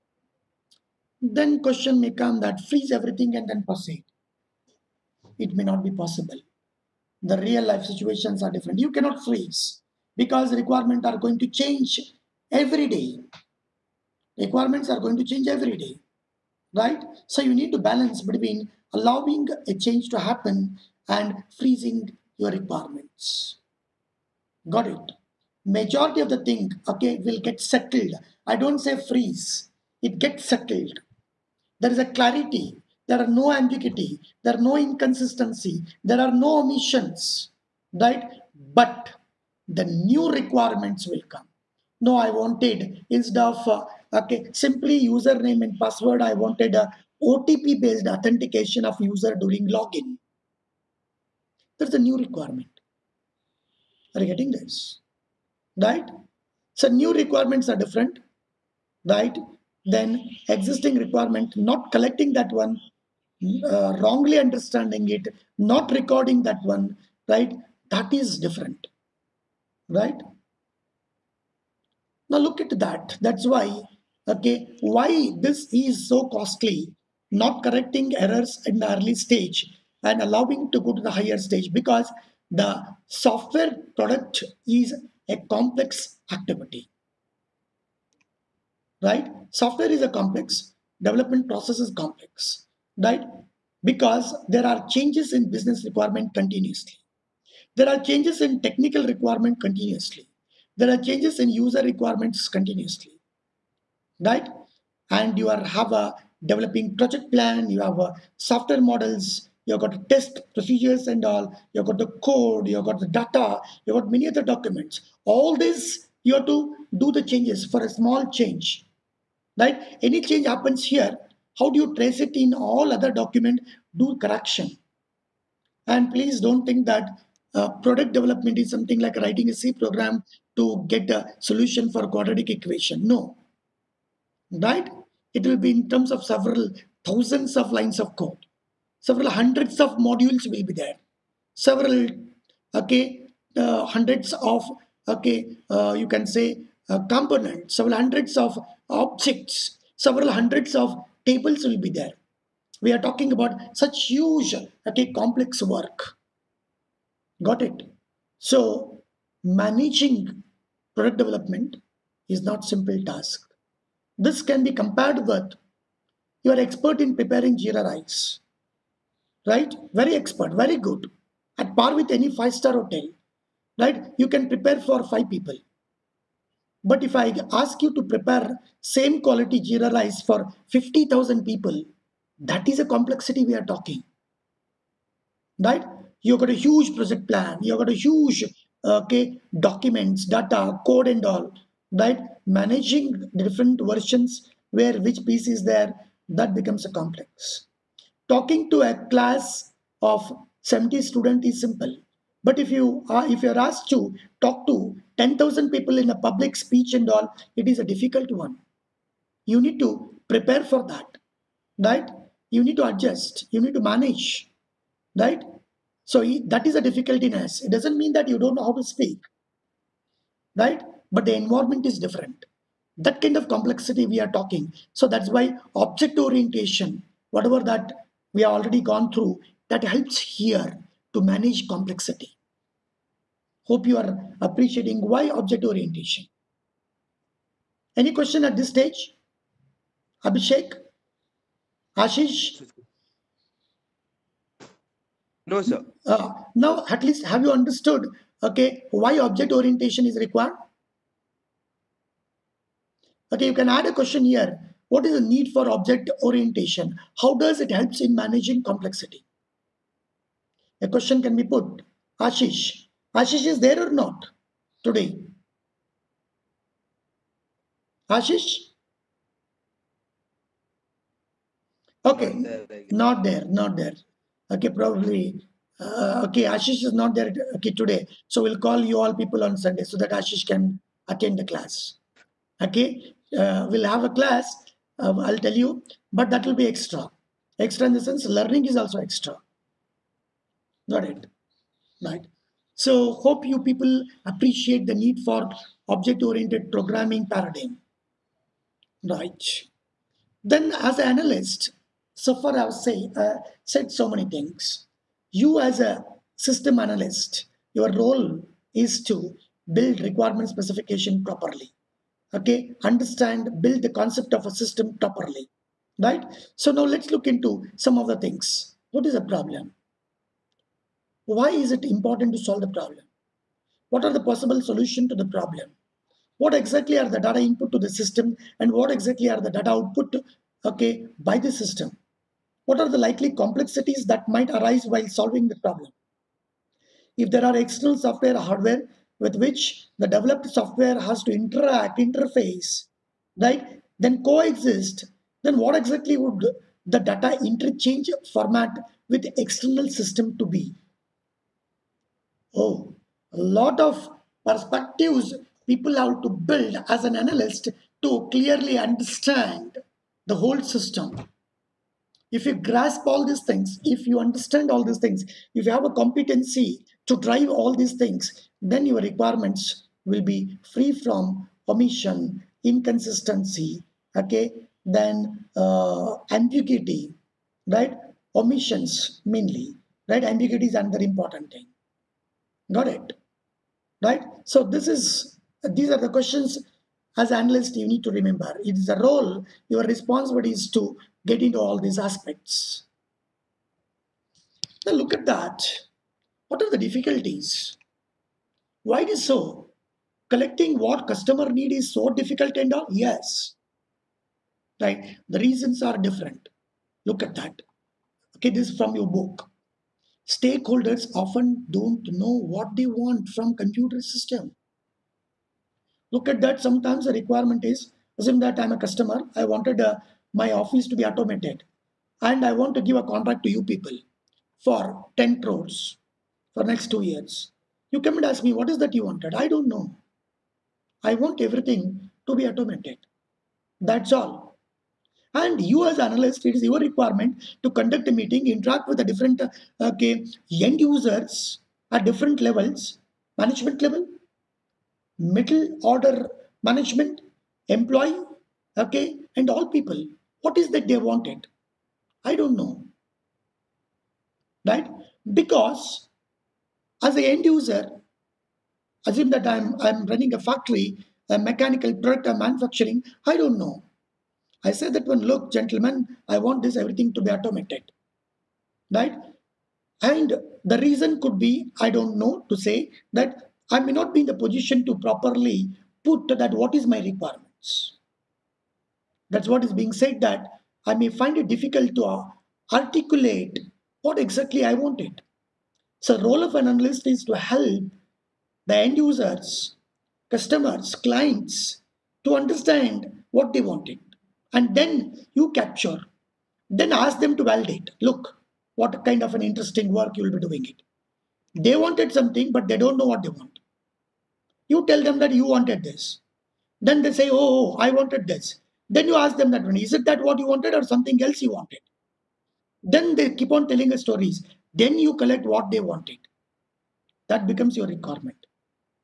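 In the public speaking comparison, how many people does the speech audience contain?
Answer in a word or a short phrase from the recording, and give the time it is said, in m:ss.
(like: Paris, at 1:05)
10,000, at 3:25.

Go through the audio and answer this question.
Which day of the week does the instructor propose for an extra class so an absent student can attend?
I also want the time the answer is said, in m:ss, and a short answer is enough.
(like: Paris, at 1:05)
Sunday, at 4:39.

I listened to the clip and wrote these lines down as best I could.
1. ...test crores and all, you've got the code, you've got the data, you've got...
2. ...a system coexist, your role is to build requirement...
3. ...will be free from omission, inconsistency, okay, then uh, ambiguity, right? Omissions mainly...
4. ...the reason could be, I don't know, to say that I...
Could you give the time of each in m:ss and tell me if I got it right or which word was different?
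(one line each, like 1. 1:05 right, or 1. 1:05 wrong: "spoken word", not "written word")
1. 1:50 wrong: "procedures", not "crores"
2. 5:05 wrong: "analyst", not "coexist"
3. 6:10 right
4. 7:50 right.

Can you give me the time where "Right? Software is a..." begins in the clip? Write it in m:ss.
1:29.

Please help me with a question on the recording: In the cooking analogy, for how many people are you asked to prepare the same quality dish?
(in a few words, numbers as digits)
50,000.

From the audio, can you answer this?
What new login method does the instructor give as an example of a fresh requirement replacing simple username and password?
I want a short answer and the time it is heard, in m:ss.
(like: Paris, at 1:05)
OTP based authentication, at 0:47.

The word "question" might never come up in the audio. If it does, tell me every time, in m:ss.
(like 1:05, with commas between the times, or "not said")
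0:01, 3:58, 4:13, 4:20, 6:26.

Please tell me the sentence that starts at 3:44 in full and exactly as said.
So that's why object orientation, whatever that we have already gone through that helps here to manage complexity.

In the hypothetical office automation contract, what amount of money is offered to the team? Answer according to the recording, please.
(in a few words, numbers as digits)
10 crores.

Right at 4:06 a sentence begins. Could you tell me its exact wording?
Uh, now, at least have you understood, okay, why object orientation is required?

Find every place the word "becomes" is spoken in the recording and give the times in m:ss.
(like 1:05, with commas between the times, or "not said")
3:16, 8:37.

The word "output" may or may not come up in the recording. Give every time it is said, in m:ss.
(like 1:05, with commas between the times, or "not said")
5:29.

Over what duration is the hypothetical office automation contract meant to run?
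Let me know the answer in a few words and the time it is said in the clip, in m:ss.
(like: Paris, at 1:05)
two years, at 7:06.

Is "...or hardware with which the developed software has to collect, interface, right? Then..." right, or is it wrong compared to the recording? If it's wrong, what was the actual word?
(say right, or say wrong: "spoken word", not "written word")
wrong: "interact", not "collect".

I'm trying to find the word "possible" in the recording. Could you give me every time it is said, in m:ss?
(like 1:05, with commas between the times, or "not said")
0:05, 5:24.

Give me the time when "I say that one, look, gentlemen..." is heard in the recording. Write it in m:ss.
7:44.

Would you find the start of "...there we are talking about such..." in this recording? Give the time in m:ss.
2:31.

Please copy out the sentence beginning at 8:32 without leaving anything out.
Then they keep on telling us stories.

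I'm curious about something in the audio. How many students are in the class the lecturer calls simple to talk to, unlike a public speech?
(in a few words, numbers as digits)
70.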